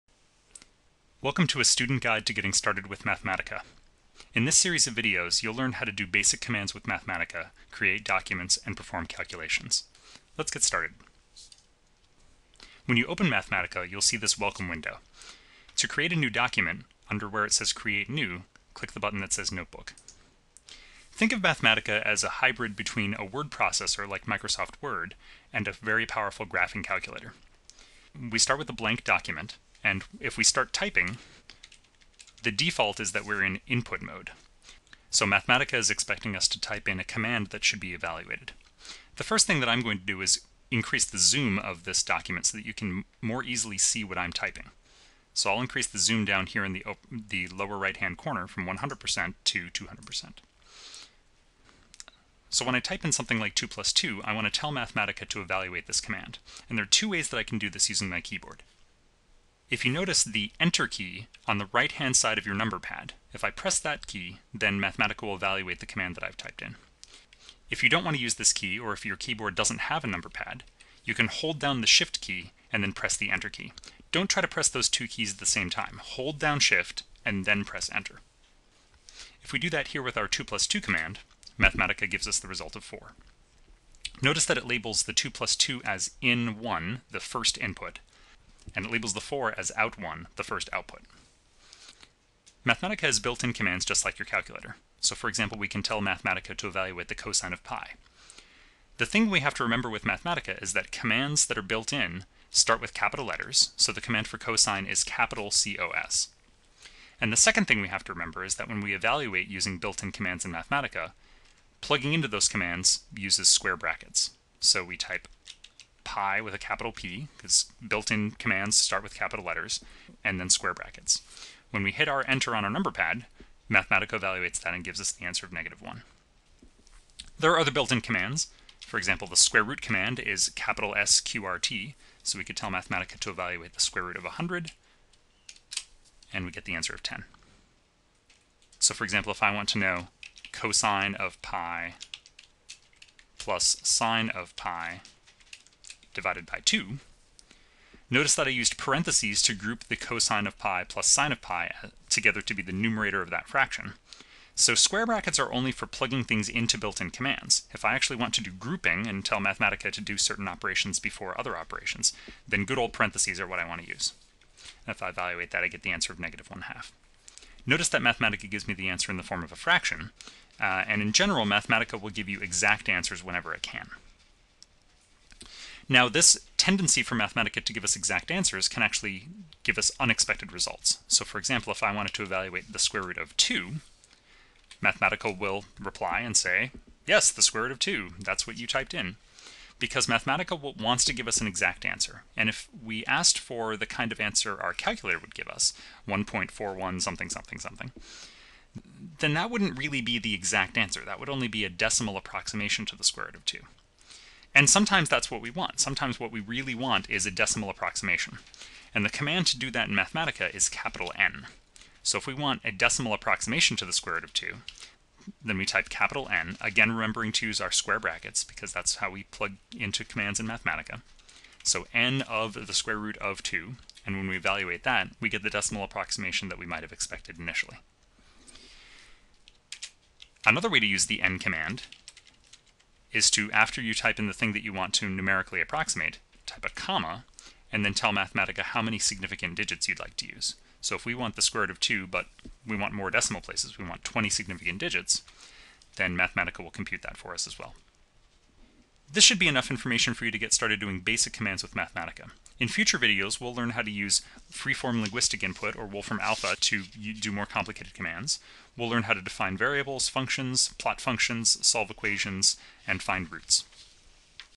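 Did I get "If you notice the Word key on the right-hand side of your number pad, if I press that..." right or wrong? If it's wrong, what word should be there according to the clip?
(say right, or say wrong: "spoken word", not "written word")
wrong: "Enter", not "Word".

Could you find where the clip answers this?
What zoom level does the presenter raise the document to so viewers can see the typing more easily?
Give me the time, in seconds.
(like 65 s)
49 s.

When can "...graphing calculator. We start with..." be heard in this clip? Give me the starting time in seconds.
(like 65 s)
26 s.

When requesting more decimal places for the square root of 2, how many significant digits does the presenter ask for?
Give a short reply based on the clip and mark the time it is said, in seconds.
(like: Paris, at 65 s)
20, at 244 s.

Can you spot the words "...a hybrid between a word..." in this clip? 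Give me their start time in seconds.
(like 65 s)
22 s.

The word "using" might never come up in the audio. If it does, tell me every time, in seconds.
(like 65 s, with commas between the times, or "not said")
57 s, 109 s.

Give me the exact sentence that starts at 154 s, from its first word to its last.
So square brackets are only for plugging things into built-in commands.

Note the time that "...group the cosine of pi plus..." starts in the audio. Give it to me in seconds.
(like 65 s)
149 s.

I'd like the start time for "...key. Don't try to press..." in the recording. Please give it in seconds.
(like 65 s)
73 s.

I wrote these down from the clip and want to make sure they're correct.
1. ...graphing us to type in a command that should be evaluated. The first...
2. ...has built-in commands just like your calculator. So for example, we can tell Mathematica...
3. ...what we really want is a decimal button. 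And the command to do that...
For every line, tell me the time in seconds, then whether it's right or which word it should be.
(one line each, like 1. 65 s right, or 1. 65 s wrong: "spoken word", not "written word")
1. 35 s wrong: "expecting", not "graphing"
2. 93 s right
3. 206 s wrong: "approximation", not "button".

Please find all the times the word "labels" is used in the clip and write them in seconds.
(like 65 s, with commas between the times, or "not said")
84 s, 88 s.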